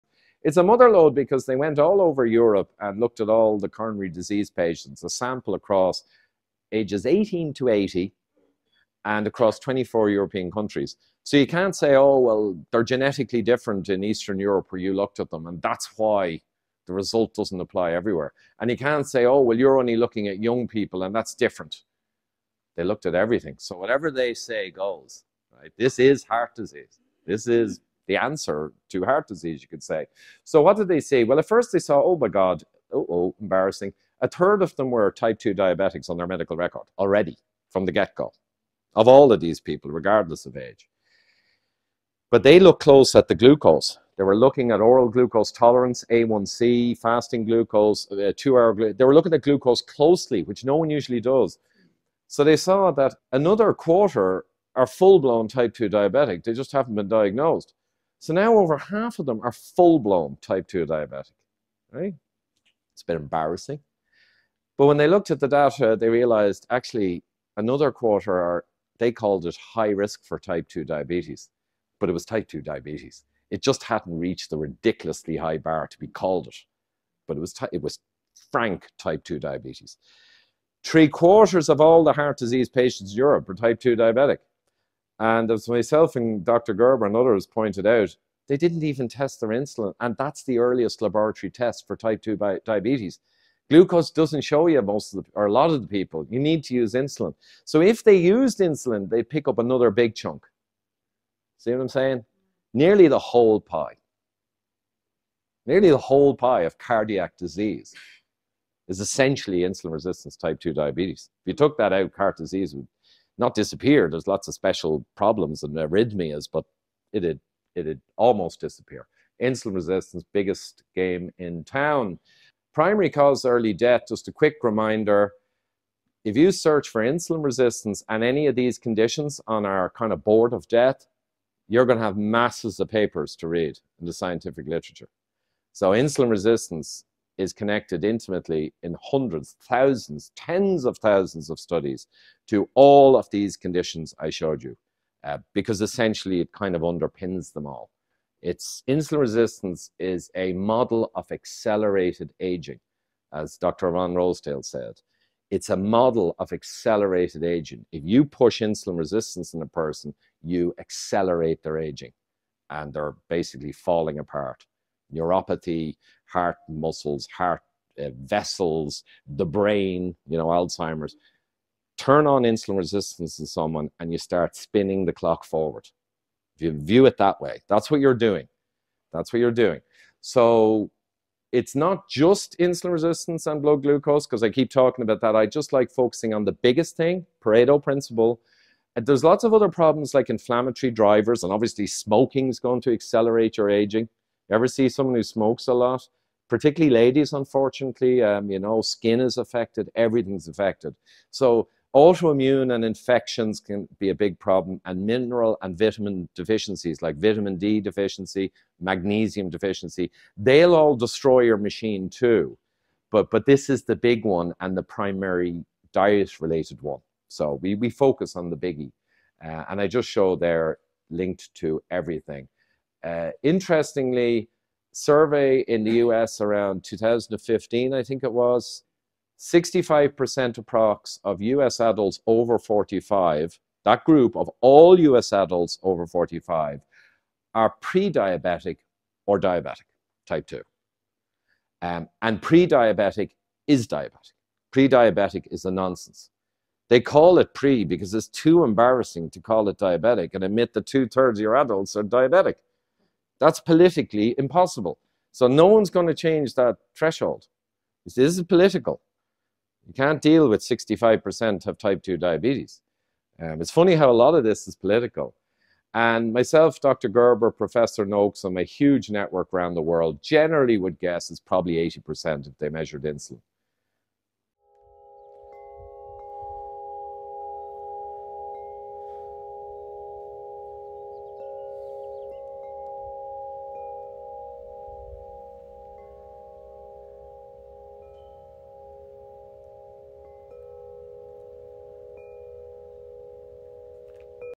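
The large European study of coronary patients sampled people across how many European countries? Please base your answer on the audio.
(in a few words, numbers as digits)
24.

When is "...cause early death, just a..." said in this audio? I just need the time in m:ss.
2:03.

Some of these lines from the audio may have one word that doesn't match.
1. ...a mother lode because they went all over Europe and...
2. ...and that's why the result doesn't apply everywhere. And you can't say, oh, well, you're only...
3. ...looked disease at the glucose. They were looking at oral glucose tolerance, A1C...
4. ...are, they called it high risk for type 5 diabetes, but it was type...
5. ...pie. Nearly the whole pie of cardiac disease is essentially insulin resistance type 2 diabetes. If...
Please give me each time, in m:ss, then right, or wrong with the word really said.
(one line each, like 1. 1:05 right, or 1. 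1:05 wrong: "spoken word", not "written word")
1. 0:00 right
2. 0:15 right
3. 0:42 wrong: "close", not "disease"
4. 1:08 wrong: "2", not "5"
5. 1:43 right.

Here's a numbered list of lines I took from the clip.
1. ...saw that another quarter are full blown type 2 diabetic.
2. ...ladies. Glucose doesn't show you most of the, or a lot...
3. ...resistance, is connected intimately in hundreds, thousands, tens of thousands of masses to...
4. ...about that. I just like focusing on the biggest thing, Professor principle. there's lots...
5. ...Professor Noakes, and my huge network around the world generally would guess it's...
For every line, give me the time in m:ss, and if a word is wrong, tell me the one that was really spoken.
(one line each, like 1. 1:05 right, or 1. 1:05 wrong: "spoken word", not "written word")
1. 0:52 right
2. 1:32 wrong: "diabetes", not "ladies"
3. 2:16 wrong: "studies", not "masses"
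4. 3:05 wrong: "Pareto", not "Professor"
5. 4:27 right.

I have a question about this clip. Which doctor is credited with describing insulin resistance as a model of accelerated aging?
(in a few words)
Dr. Ron Rosedale.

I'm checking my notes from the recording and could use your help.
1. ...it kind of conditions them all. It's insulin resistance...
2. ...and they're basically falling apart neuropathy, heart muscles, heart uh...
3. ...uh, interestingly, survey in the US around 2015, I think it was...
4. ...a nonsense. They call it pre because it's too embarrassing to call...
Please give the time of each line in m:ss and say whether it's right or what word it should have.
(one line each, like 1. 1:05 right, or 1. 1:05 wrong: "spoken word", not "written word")
1. 2:26 wrong: "underpins", not "conditions"
2. 2:42 right
3. 3:43 right
4. 4:05 right.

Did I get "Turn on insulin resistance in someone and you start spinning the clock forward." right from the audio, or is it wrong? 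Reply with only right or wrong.
right.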